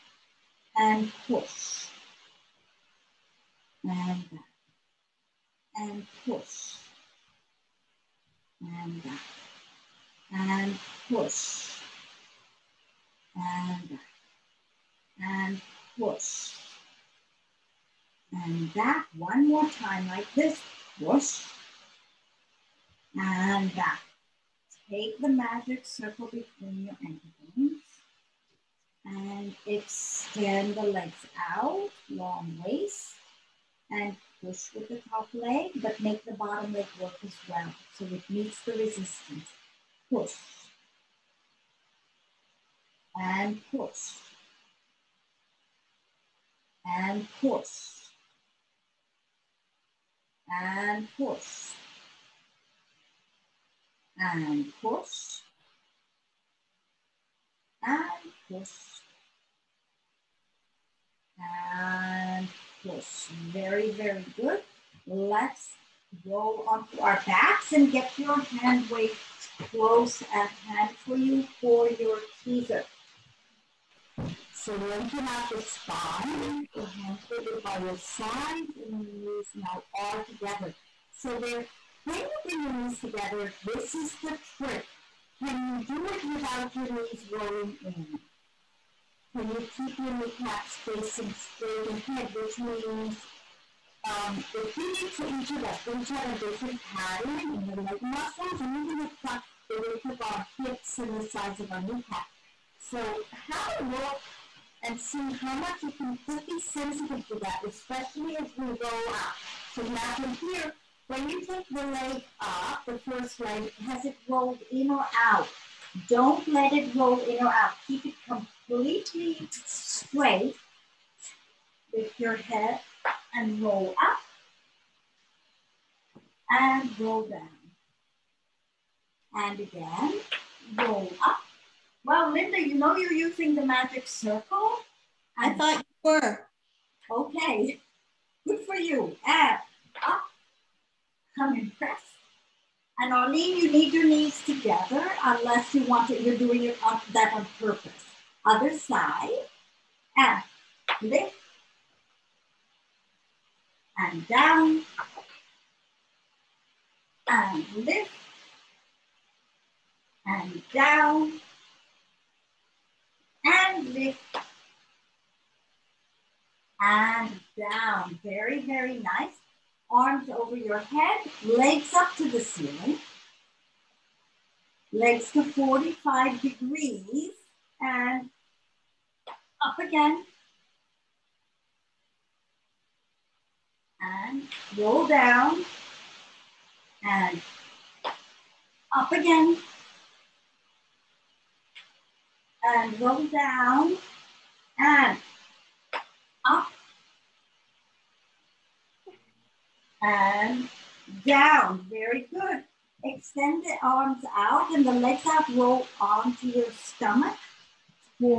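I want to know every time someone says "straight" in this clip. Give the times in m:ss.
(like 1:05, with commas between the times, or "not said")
1:31, 1:59.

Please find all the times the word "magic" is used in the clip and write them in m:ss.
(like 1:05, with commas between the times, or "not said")
0:25, 2:13.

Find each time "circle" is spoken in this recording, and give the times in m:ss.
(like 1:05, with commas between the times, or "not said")
0:25, 2:14.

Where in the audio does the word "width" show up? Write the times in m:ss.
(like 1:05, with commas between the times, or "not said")
1:39.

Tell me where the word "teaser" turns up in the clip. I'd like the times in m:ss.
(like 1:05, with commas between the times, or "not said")
1:12.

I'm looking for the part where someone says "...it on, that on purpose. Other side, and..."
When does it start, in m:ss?
2:26.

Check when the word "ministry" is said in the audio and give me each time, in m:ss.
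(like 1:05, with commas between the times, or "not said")
not said.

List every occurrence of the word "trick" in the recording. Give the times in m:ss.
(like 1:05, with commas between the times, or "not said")
1:24.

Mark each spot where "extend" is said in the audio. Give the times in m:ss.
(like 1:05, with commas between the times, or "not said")
0:29, 3:23.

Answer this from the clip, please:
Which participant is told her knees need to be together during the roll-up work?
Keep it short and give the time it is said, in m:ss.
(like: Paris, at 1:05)
Arlene, at 2:23.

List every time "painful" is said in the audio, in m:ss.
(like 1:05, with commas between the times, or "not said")
not said.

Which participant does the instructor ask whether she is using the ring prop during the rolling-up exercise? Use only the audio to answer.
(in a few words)
Linda.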